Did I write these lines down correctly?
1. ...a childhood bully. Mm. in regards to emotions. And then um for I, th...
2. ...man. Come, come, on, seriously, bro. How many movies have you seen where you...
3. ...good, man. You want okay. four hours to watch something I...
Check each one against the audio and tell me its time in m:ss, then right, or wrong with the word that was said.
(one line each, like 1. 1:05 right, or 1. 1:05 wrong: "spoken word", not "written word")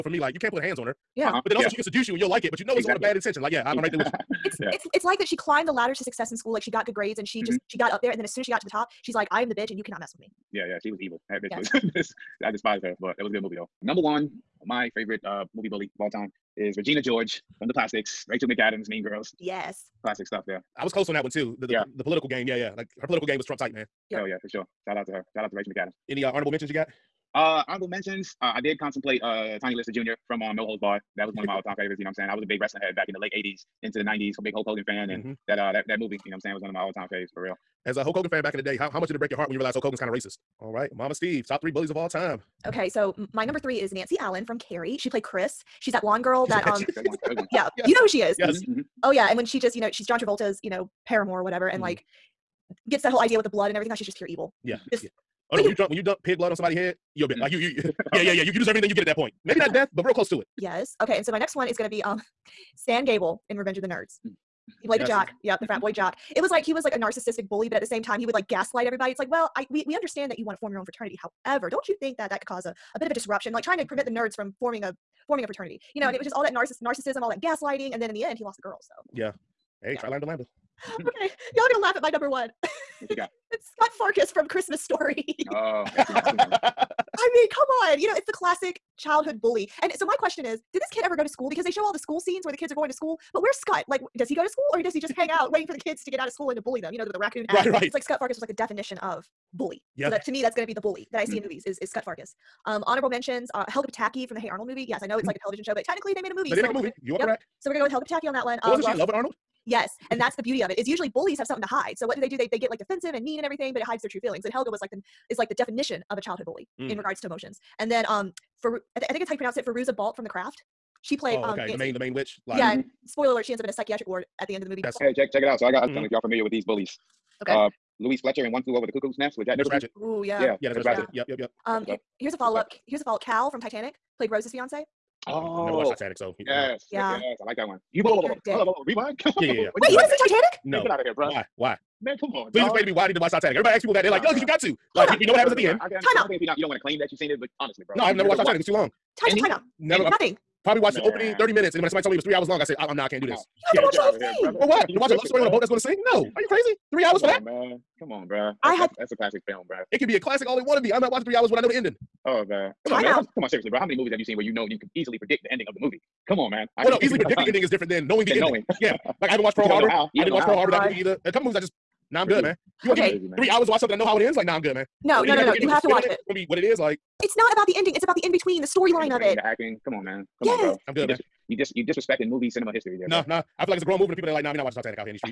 1. 1:56 right
2. 2:43 right
3. 2:52 wrong: "three", not "four".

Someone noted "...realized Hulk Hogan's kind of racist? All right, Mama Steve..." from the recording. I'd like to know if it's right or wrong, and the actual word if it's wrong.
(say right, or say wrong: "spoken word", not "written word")
right.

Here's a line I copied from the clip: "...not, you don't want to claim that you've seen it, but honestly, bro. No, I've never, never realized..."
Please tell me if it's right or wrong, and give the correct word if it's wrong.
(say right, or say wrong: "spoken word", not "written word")
wrong: "watched", not "realized".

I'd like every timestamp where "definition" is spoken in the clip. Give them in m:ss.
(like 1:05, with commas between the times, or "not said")
1:38, 1:55.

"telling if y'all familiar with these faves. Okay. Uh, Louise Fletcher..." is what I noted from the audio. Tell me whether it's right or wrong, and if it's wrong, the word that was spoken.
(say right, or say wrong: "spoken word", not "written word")
wrong: "bullies", not "faves".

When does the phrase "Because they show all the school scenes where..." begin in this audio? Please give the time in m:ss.
1:31.